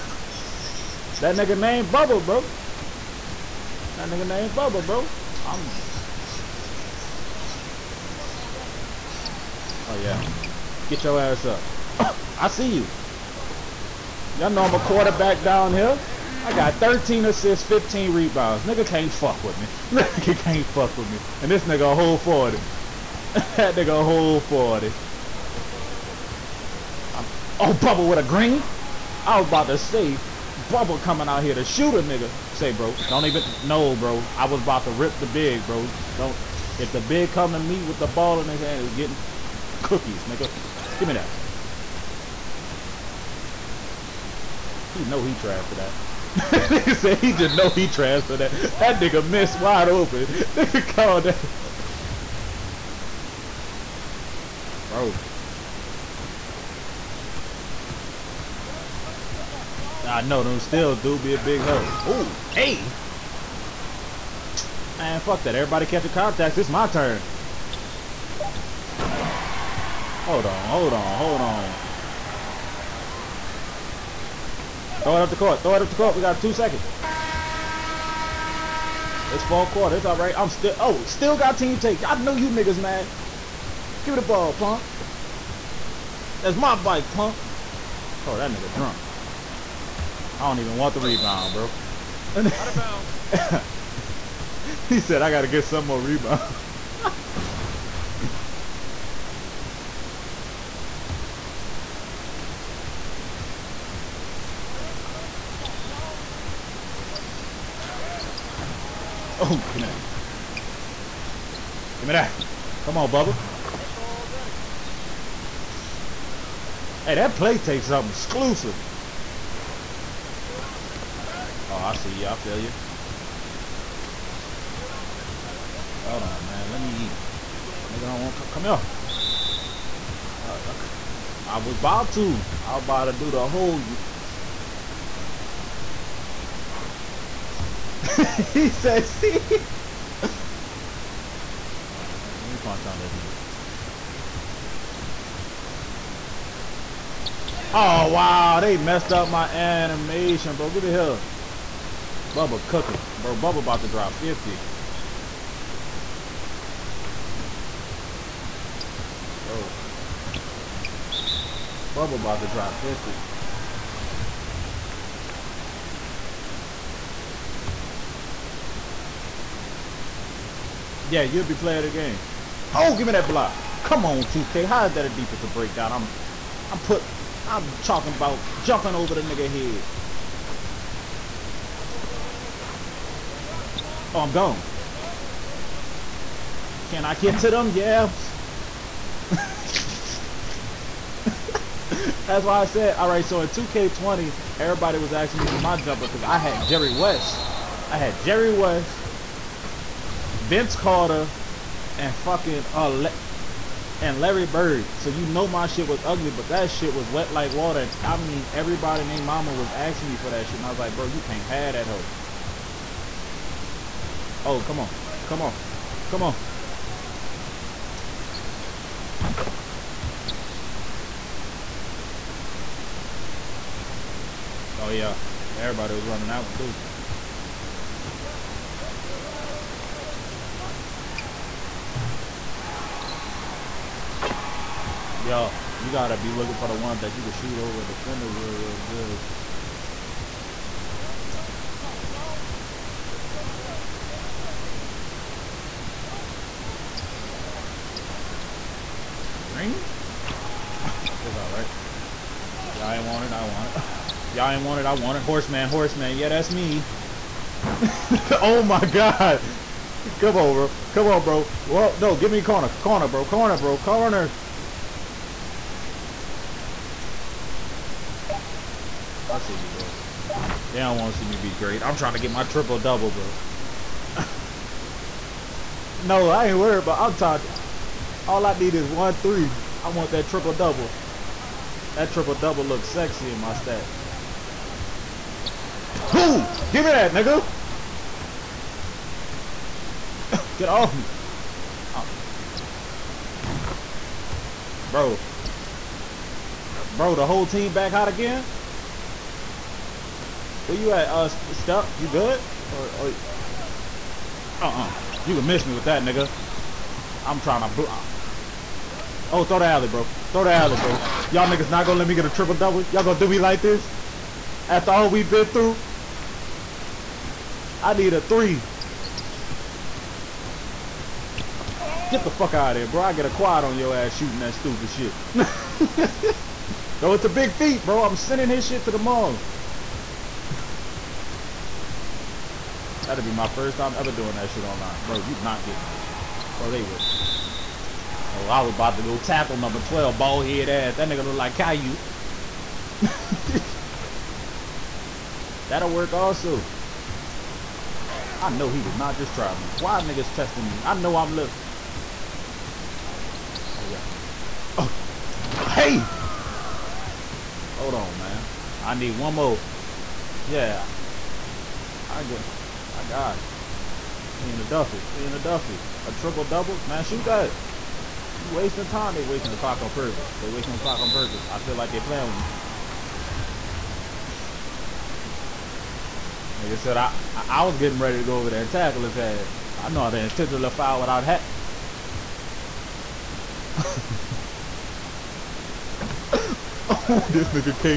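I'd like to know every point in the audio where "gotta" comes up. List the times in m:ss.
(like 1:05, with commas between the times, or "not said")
3:55.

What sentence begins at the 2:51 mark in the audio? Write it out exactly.
Yeah, you'll be player of the game.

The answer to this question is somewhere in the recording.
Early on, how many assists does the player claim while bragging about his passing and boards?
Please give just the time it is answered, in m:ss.
0:16.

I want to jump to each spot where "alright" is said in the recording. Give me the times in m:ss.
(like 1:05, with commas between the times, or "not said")
4:11.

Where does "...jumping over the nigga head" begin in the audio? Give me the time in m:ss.
2:58.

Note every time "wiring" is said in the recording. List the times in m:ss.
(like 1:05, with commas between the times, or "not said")
not said.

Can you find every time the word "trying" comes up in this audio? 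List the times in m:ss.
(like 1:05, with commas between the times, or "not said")
4:31, 5:07.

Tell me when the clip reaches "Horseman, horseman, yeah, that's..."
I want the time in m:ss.
4:15.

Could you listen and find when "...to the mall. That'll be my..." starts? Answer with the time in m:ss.
5:28.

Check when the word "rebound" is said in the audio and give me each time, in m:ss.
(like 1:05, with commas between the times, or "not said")
0:18, 1:31, 1:36.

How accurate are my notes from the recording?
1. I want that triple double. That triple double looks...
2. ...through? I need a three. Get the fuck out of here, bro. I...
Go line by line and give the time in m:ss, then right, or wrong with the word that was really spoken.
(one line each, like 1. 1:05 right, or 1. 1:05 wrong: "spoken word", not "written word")
1. 4:39 right
2. 5:15 right.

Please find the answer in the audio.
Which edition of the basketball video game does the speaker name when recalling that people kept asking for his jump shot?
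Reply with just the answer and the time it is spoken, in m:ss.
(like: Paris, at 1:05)
2K20, at 3:13.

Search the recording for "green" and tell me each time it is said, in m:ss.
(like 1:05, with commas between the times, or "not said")
0:28, 4:09.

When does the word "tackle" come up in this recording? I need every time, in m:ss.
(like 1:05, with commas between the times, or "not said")
5:39, 6:18.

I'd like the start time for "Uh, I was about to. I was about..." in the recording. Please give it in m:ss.
2:10.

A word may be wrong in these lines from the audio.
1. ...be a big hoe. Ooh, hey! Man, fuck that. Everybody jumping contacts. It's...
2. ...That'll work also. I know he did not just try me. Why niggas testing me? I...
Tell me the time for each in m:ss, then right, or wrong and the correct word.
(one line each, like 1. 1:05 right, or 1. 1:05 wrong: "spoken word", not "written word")
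1. 1:01 wrong: "catching", not "jumping"
2. 5:45 right.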